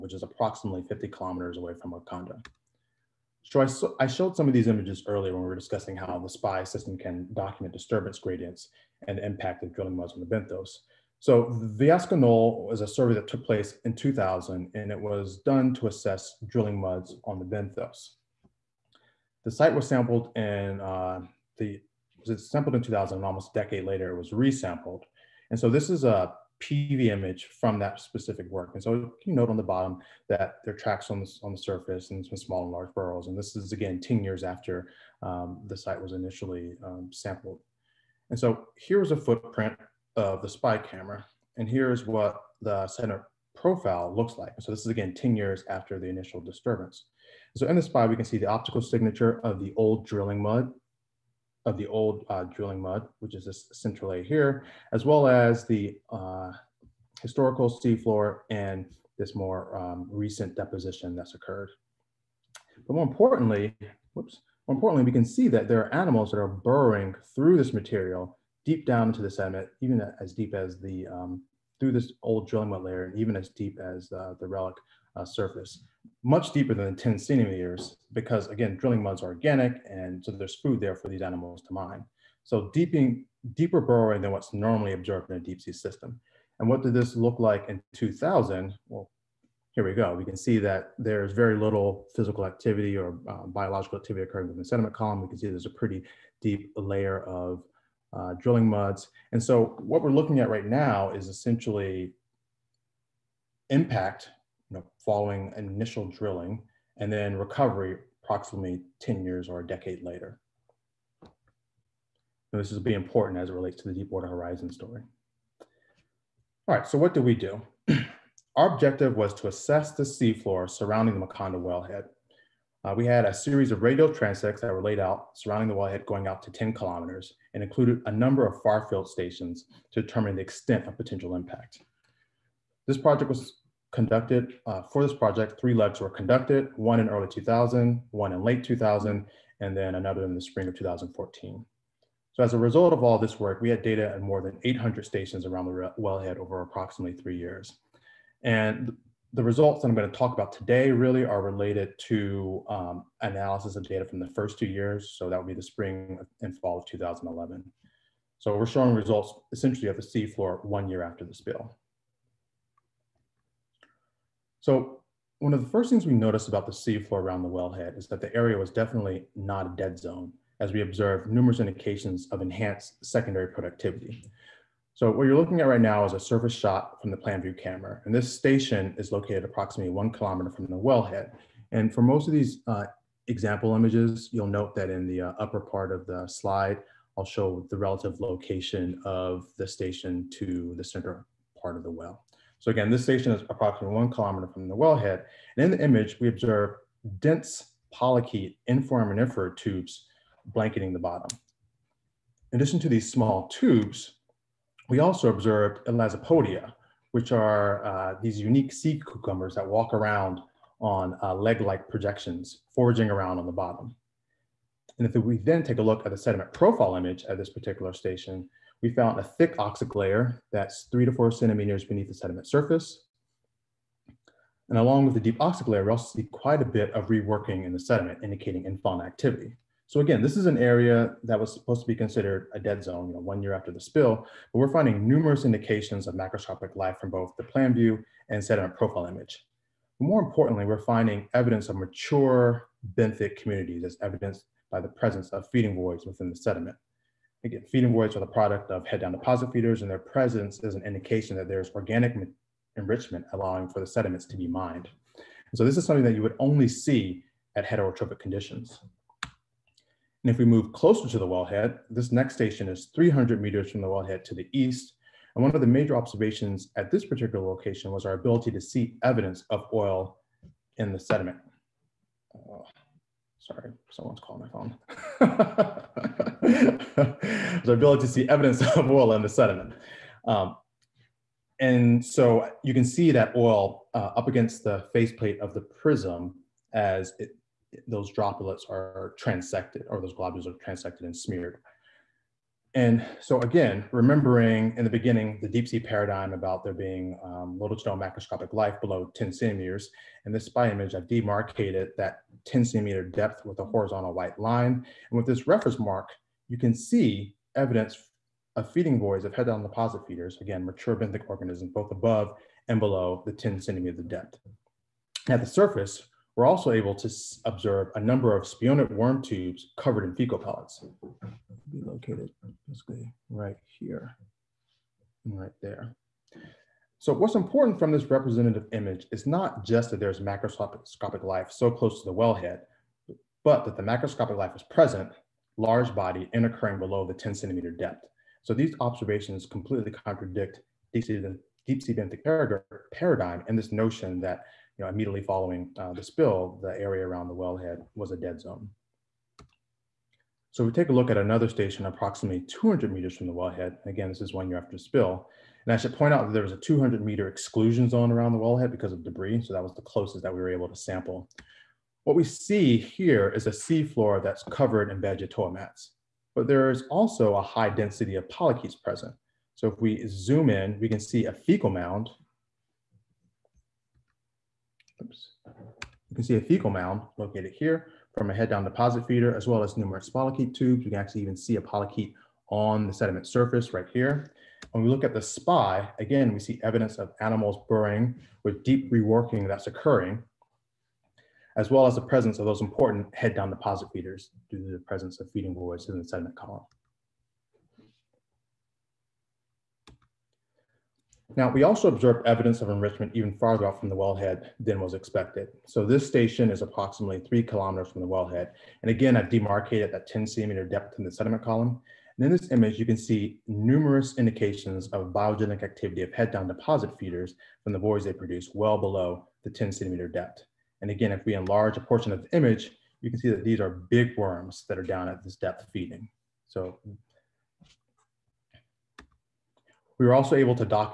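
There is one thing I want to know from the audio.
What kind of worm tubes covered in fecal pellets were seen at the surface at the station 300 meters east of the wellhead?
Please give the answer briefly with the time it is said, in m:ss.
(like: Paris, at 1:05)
spionid, at 5:18.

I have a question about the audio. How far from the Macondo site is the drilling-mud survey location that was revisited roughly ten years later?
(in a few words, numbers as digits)
50 kilometers.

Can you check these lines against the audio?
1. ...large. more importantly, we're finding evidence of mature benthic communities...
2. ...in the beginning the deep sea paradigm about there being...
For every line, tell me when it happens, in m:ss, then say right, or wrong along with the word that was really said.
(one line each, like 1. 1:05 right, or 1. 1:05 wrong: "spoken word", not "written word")
1. 3:59 wrong: "image", not "large"
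2. 4:54 right.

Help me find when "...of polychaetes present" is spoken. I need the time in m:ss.
6:08.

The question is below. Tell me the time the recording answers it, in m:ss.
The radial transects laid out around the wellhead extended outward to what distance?
2:06.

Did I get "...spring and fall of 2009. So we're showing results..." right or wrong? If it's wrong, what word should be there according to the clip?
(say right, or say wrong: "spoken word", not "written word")
wrong: "2011", not "2009".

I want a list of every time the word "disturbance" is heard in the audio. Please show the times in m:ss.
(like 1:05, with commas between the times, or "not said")
0:07, 0:46.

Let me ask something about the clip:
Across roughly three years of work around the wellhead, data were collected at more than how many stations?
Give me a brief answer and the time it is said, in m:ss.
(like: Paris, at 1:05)
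800, at 2:24.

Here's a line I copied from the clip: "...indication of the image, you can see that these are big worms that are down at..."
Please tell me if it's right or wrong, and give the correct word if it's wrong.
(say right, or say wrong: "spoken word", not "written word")
wrong: "portion", not "indication".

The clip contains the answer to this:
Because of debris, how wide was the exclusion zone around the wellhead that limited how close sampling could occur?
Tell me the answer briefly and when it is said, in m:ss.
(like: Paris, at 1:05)
200 meters, at 5:56.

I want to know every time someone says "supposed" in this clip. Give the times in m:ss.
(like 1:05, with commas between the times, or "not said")
3:51.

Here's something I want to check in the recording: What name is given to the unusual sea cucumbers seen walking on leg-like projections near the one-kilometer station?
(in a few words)
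elasopodia.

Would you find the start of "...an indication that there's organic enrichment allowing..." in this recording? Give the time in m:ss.
4:10.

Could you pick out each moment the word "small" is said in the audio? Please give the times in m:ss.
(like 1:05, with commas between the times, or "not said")
0:32, 3:23.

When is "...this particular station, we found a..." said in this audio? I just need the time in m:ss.
3:37.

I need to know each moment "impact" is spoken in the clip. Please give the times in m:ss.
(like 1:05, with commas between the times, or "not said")
0:09, 1:43, 2:11.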